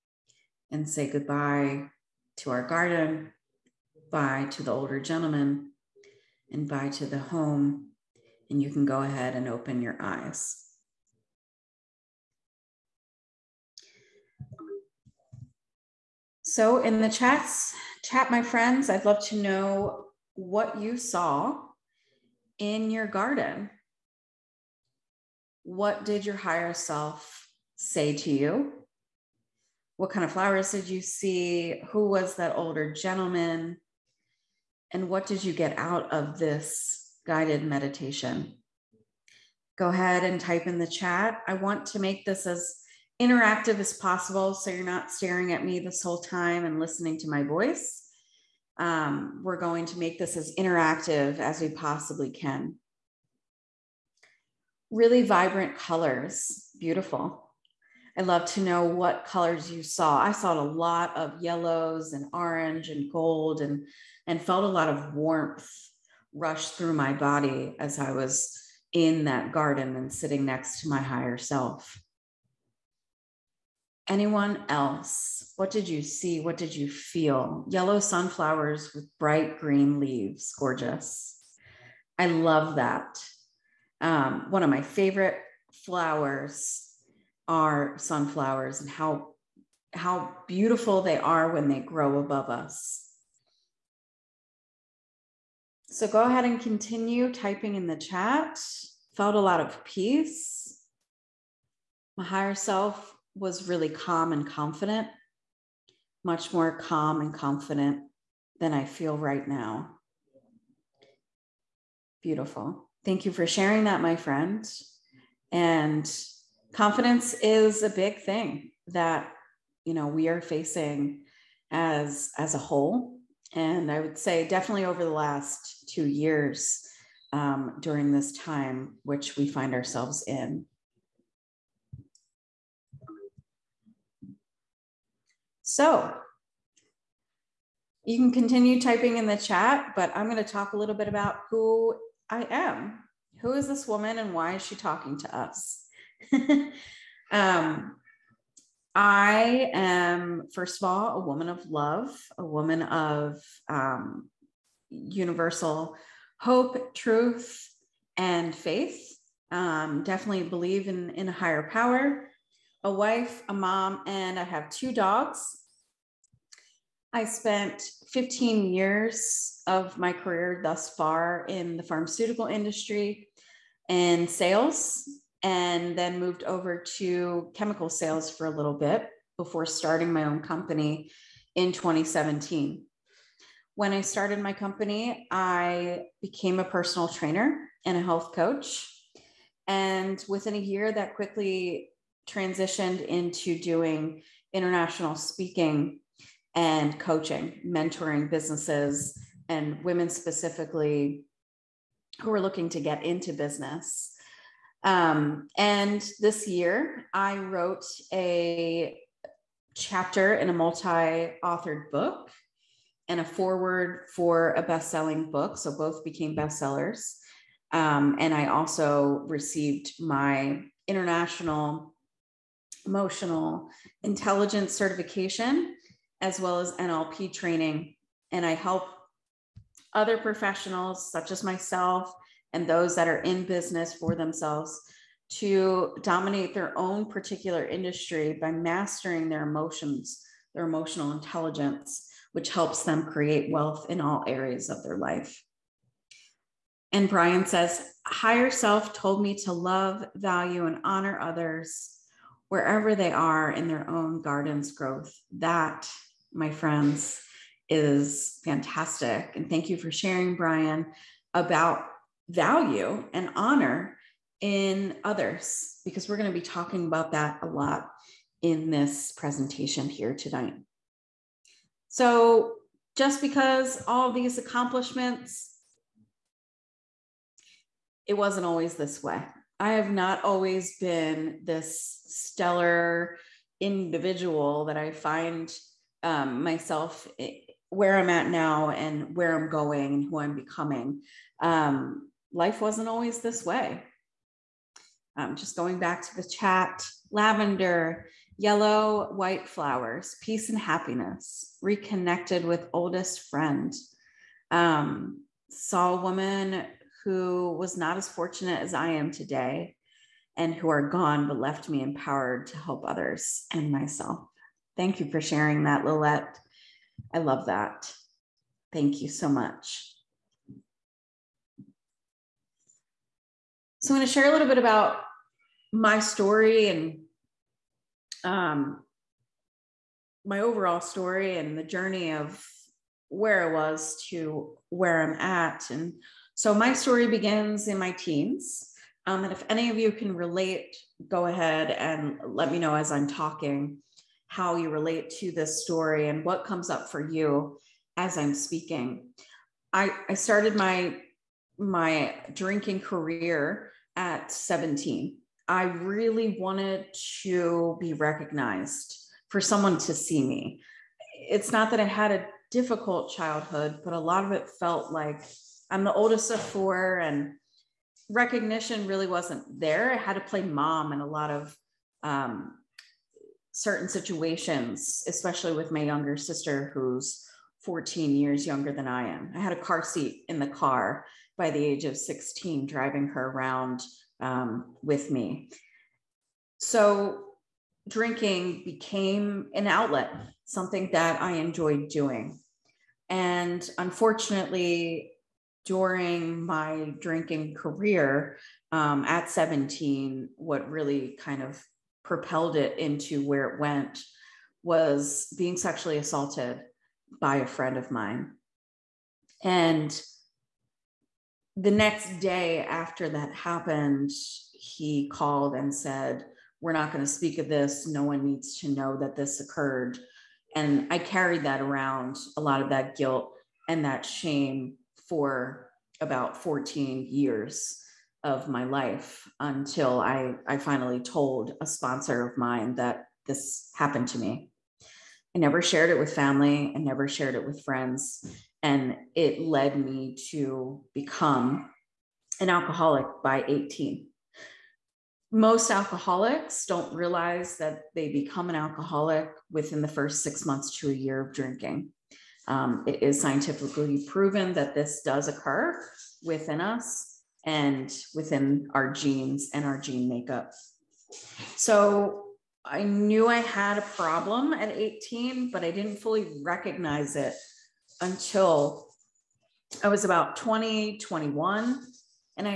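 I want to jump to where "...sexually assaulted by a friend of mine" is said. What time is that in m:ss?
6:45.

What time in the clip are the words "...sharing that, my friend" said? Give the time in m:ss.
1:53.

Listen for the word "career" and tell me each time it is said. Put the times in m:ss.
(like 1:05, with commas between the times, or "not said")
2:50, 5:52, 6:37.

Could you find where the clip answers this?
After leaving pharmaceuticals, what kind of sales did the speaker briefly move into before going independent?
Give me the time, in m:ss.
2:57.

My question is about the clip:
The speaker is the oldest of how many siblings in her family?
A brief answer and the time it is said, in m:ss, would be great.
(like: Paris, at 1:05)
4, at 6:06.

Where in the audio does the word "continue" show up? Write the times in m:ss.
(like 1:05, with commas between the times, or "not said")
1:36, 2:18.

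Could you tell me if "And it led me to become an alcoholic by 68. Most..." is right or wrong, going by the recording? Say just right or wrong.
wrong.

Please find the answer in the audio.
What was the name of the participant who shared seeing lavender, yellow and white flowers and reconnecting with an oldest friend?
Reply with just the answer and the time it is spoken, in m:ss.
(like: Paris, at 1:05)
Lillette, at 5:15.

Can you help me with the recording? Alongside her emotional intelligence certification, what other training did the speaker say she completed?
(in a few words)
NLP training.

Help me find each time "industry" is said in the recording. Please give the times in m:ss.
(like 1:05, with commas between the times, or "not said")
2:52, 3:57.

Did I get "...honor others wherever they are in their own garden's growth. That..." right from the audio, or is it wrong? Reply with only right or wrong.
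right.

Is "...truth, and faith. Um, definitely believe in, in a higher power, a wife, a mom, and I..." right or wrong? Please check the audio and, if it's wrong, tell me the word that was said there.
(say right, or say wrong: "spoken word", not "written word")
right.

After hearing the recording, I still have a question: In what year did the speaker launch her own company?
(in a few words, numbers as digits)
2017.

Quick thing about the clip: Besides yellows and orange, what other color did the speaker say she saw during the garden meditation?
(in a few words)
gold.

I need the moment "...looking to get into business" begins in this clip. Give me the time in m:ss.
3:22.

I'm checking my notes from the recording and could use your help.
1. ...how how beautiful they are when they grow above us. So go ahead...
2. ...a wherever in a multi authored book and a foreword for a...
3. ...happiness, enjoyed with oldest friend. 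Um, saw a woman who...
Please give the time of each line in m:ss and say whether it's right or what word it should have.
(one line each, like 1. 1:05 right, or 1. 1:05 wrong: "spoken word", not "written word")
1. 1:28 right
2. 3:28 wrong: "chapter", not "wherever"
3. 5:00 wrong: "reconnected", not "enjoyed".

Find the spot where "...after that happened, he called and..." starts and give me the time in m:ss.
6:52.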